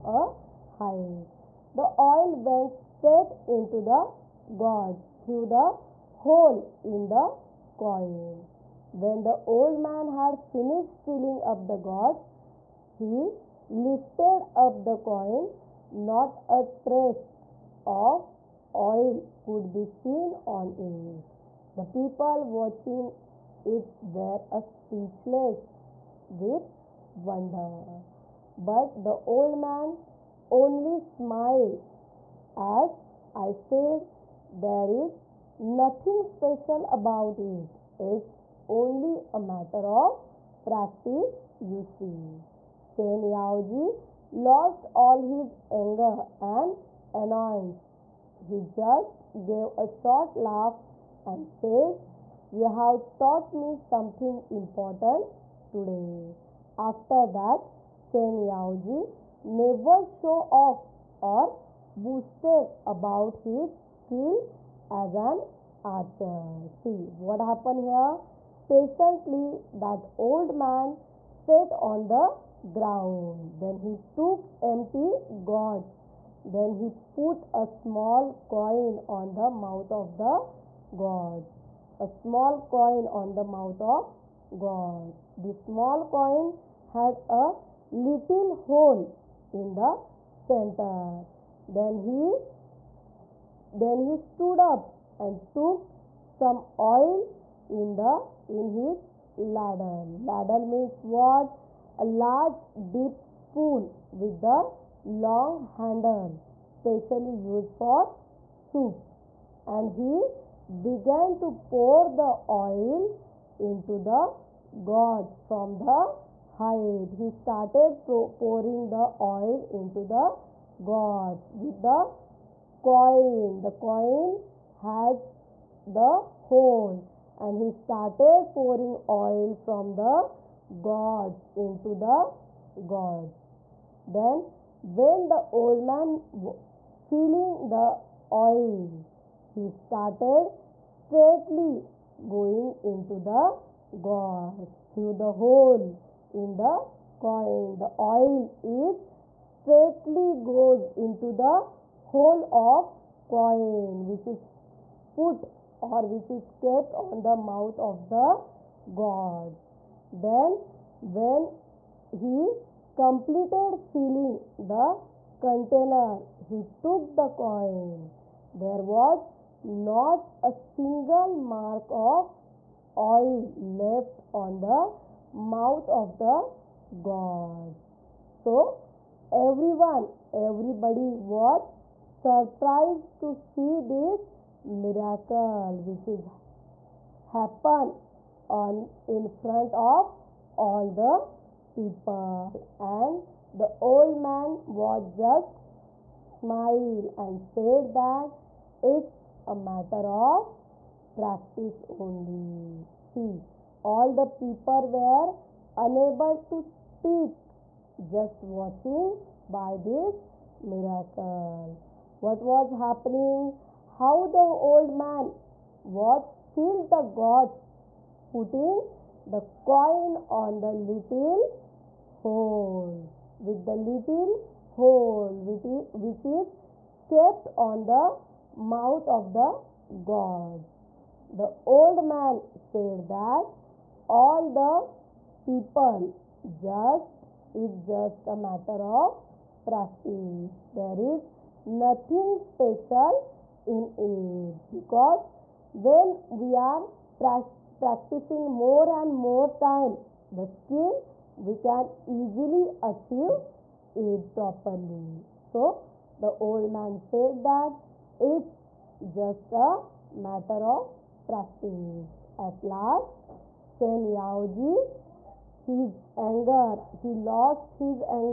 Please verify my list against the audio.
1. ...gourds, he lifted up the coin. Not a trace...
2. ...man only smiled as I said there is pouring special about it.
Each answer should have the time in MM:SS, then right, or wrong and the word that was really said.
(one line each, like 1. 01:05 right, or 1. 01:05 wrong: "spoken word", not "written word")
1. 00:11 right
2. 00:29 wrong: "nothing", not "pouring".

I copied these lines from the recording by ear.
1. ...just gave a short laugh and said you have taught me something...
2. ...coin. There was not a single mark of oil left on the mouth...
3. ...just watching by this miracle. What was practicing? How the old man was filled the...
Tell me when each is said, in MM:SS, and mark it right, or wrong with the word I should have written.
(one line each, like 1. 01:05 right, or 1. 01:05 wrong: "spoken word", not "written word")
1. 00:48 right
2. 02:47 right
3. 03:28 wrong: "happening", not "practicing".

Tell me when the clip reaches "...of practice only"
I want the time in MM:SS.
03:20.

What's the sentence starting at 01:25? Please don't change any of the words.
This small coin had a little hole in the center.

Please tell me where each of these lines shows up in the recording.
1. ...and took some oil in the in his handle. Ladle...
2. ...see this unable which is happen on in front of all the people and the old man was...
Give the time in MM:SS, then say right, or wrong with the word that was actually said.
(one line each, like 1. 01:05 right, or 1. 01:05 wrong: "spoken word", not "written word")
1. 01:35 wrong: "ladle", not "handle"
2. 03:03 wrong: "miracle", not "unable".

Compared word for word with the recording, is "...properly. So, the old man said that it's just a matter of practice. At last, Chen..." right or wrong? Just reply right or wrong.
right.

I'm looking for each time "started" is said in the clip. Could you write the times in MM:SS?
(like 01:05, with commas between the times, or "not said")
01:57, 02:07, 02:19.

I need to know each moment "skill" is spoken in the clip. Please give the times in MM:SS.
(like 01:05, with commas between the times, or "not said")
01:03, 04:10.